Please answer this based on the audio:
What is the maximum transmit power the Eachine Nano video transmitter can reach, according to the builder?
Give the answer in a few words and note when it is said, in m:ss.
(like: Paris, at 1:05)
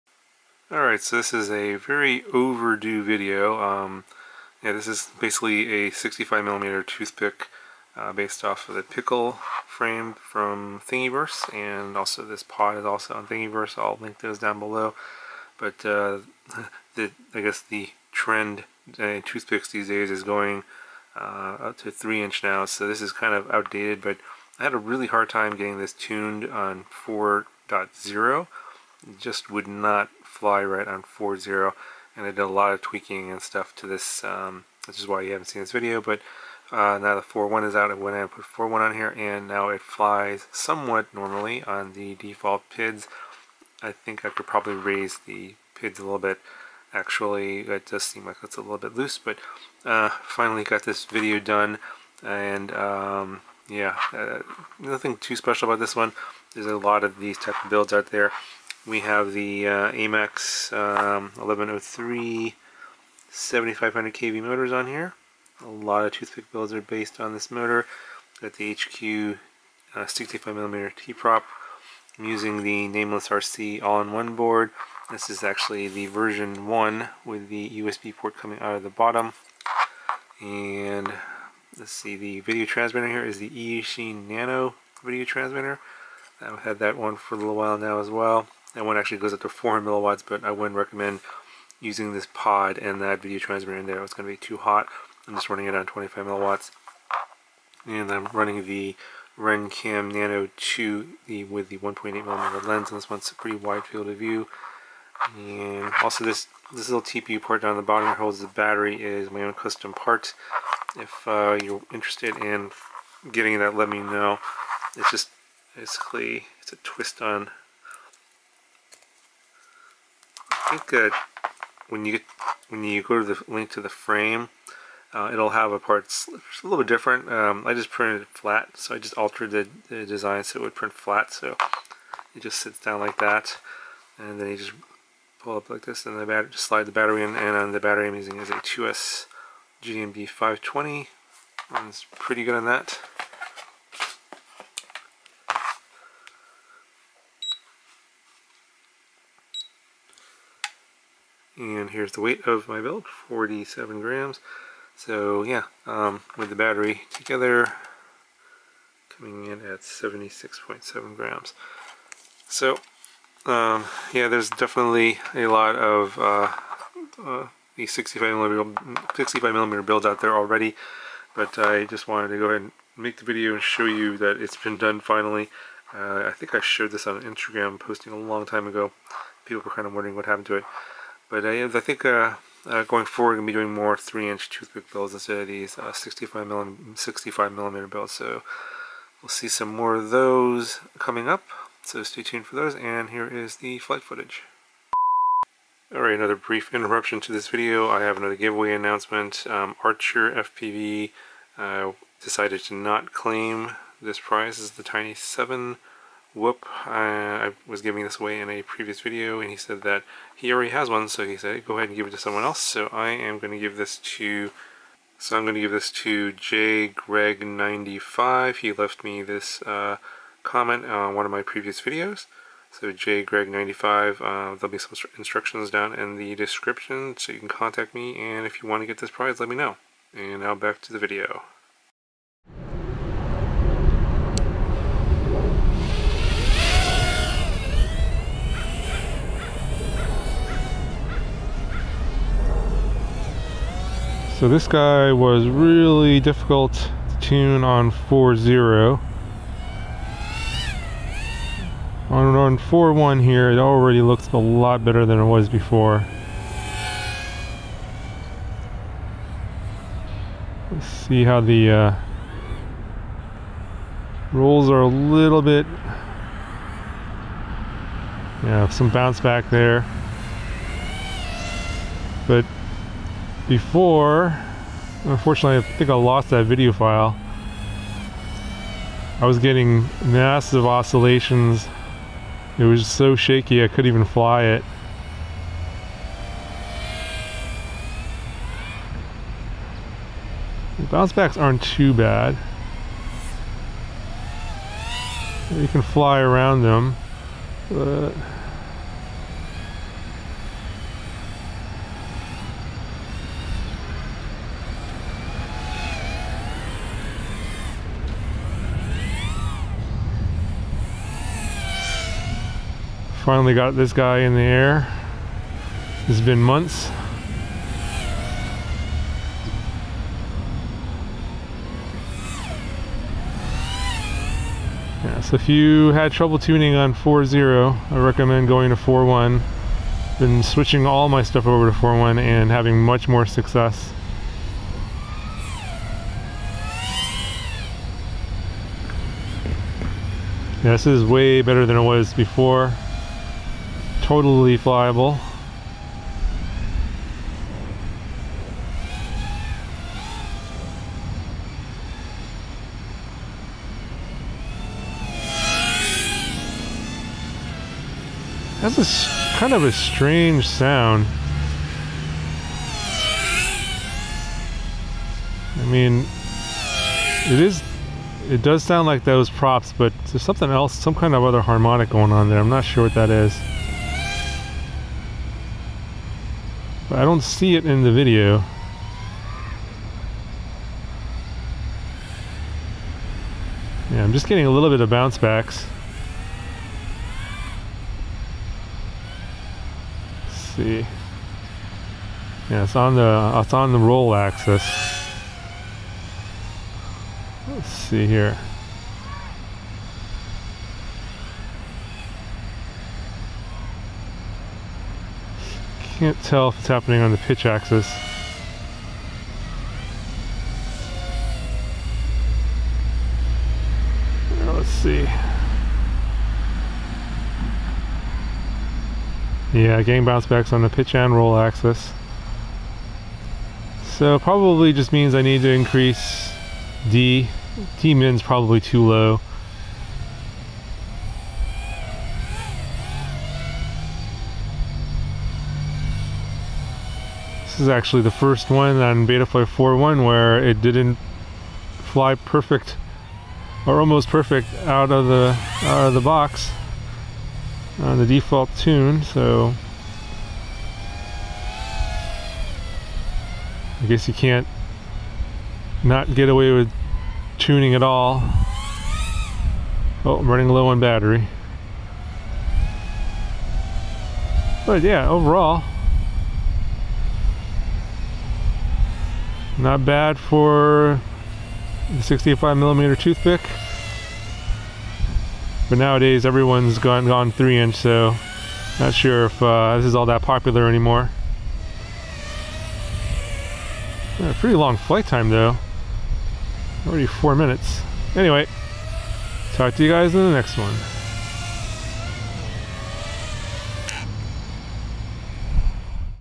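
400 milliwatts, at 1:29.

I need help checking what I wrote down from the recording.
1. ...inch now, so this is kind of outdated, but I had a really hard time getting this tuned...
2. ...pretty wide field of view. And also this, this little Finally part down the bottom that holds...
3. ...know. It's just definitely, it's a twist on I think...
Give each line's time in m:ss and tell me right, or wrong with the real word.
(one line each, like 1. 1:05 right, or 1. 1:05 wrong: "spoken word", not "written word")
1. 0:22 right
2. 1:43 wrong: "TPU", not "Finally"
3. 1:53 wrong: "basically", not "definitely".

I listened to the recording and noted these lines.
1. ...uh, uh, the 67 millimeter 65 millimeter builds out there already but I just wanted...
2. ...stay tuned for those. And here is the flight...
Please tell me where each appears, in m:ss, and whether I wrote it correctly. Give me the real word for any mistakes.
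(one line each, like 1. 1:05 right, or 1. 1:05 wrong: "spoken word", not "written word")
1. 2:46 wrong: "65", not "67"
2. 3:12 right.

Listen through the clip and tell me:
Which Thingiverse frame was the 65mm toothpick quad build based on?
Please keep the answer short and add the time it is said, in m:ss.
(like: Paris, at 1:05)
Pickle frame, at 0:08.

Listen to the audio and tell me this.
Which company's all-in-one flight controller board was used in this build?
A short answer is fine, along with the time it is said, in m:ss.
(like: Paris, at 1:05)
Nameless RC, at 1:12.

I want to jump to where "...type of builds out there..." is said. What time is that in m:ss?
0:57.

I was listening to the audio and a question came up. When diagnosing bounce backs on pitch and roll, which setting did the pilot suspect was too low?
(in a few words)
D min.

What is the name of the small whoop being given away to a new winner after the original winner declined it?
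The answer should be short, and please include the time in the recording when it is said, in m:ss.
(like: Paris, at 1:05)
Tiny 7, at 3:24.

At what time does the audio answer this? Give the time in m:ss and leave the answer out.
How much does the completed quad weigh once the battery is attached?
2:39.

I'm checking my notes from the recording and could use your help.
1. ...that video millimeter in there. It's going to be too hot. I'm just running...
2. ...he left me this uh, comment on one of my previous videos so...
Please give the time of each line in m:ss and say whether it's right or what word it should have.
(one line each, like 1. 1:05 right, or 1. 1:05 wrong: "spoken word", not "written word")
1. 1:33 wrong: "transmitter", not "millimeter"
2. 3:38 right.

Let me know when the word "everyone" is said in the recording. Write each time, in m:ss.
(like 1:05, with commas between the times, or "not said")
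7:56.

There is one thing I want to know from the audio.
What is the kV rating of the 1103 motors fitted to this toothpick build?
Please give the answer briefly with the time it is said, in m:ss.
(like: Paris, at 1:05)
7500 kV, at 1:03.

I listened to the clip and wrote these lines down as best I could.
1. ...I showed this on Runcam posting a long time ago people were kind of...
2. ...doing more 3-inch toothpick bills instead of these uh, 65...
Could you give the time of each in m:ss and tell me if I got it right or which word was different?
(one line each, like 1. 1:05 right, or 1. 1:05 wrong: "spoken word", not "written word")
1. 2:56 wrong: "Instagram", not "Runcam"
2. 3:03 right.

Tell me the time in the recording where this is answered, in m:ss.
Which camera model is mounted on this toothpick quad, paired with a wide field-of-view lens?
1:39.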